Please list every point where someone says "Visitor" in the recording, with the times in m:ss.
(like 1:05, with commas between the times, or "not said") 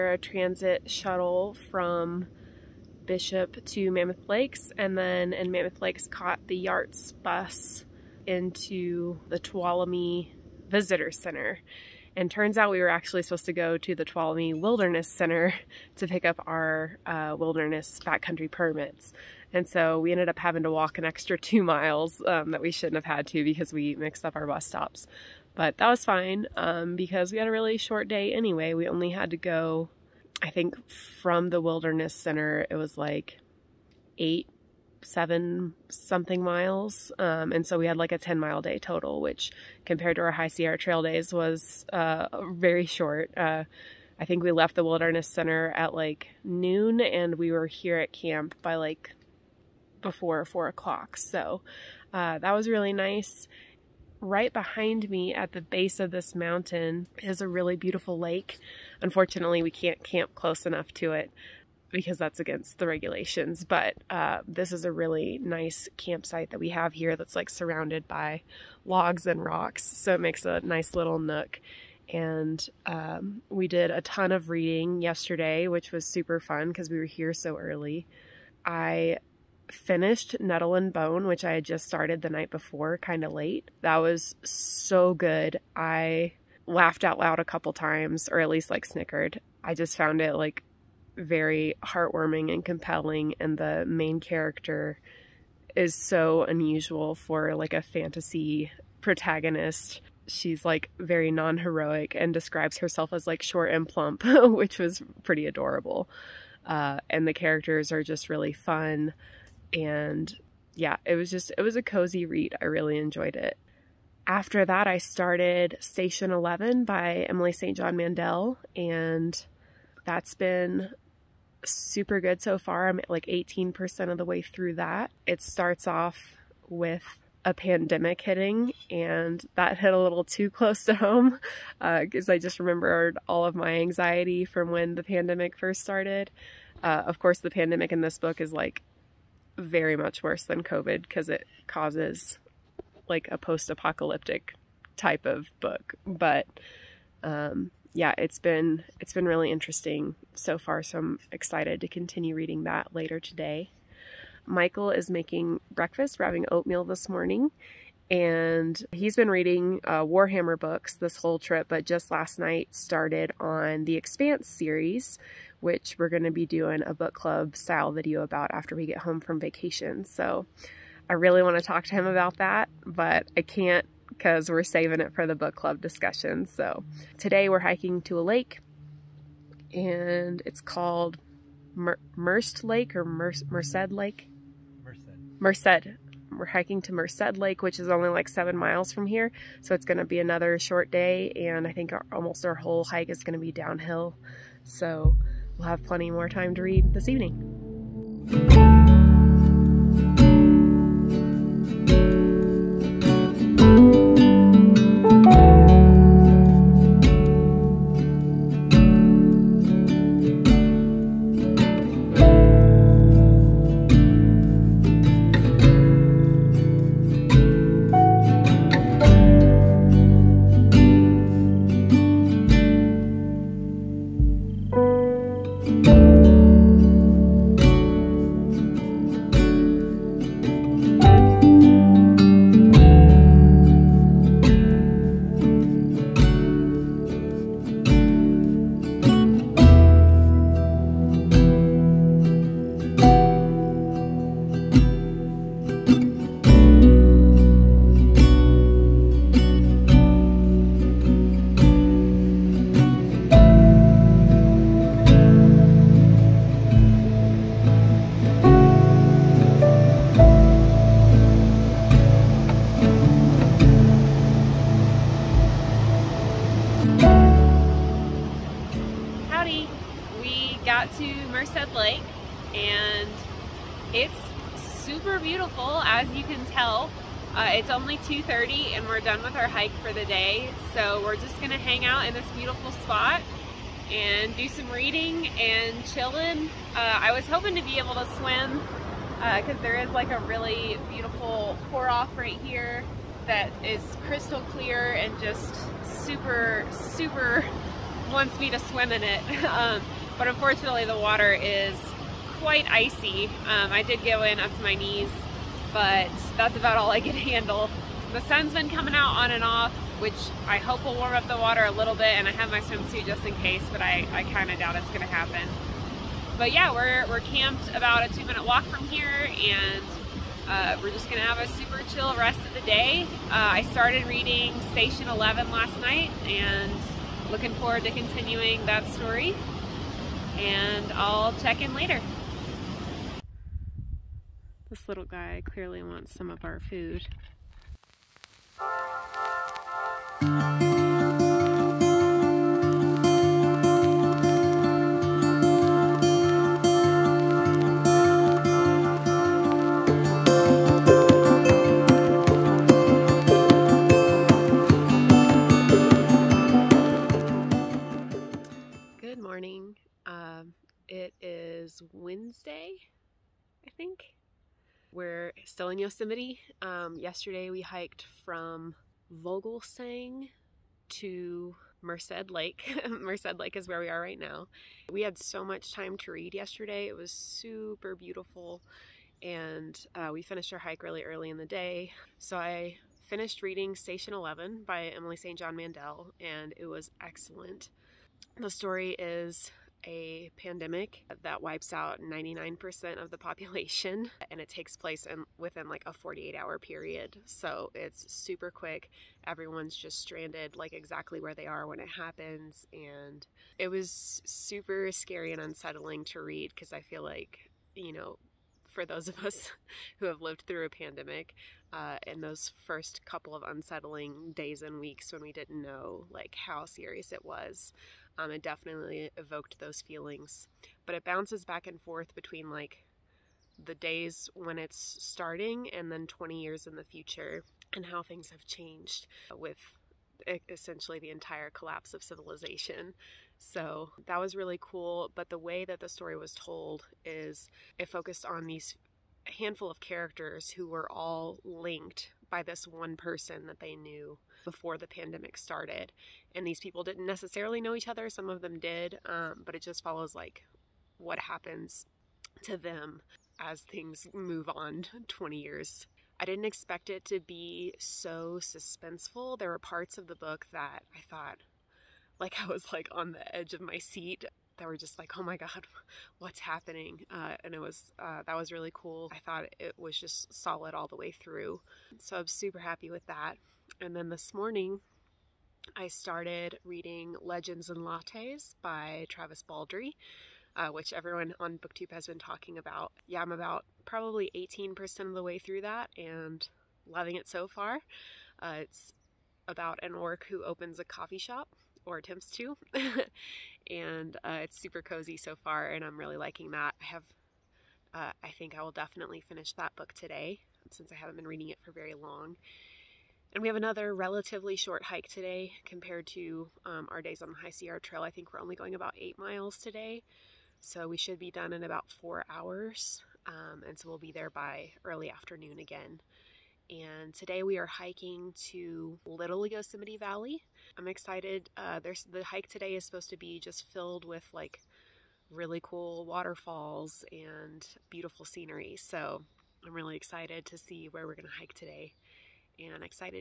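0:10.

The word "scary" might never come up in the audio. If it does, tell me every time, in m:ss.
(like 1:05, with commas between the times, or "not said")
6:44.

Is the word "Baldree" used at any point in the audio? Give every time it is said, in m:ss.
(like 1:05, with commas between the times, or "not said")
7:59.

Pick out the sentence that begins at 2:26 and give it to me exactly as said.
But um, yeah, it's been it's been really interesting so far, so I'm excited to continue reading that later today.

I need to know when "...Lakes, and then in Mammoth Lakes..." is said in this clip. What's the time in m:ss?
0:04.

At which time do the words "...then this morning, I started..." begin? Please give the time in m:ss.
7:53.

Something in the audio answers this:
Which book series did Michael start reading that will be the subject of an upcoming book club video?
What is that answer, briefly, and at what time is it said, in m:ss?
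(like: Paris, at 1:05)
The Expanse, at 2:43.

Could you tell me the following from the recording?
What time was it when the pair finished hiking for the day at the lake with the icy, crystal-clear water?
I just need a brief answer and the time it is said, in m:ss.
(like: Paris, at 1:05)
2:30, at 4:37.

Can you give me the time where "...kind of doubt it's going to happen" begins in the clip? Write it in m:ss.
5:14.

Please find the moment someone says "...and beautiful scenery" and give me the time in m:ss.
8:47.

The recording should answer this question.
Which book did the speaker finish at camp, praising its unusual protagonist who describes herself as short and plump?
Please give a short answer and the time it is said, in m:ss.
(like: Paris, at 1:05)
Nettle and Bone, at 1:20.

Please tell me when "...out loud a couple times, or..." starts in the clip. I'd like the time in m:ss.
1:27.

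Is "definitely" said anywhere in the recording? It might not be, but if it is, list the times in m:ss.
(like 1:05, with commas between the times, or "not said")
6:58, 8:18.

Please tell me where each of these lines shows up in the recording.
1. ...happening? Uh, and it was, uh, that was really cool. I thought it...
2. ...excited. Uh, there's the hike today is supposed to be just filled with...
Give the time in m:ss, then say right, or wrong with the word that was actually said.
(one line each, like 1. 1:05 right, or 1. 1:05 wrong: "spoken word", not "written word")
1. 7:46 right
2. 8:40 right.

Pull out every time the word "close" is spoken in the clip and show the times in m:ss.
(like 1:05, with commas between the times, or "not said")
1:00, 2:10.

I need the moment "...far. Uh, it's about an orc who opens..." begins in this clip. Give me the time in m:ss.
8:07.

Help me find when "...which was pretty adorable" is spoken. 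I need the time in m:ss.
1:44.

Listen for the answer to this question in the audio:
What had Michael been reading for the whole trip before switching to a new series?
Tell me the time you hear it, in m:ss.
2:40.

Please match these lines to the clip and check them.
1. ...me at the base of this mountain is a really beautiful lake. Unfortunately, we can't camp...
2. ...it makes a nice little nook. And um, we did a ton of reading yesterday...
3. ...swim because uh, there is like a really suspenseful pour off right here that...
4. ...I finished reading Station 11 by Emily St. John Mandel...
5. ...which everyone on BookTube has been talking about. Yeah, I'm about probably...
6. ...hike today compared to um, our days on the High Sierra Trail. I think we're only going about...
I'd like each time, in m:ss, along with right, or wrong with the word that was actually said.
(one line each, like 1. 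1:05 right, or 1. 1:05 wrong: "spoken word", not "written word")
1. 0:55 right
2. 1:10 right
3. 4:48 wrong: "beautiful", not "suspenseful"
4. 6:22 right
5. 8:00 right
6. 8:24 right.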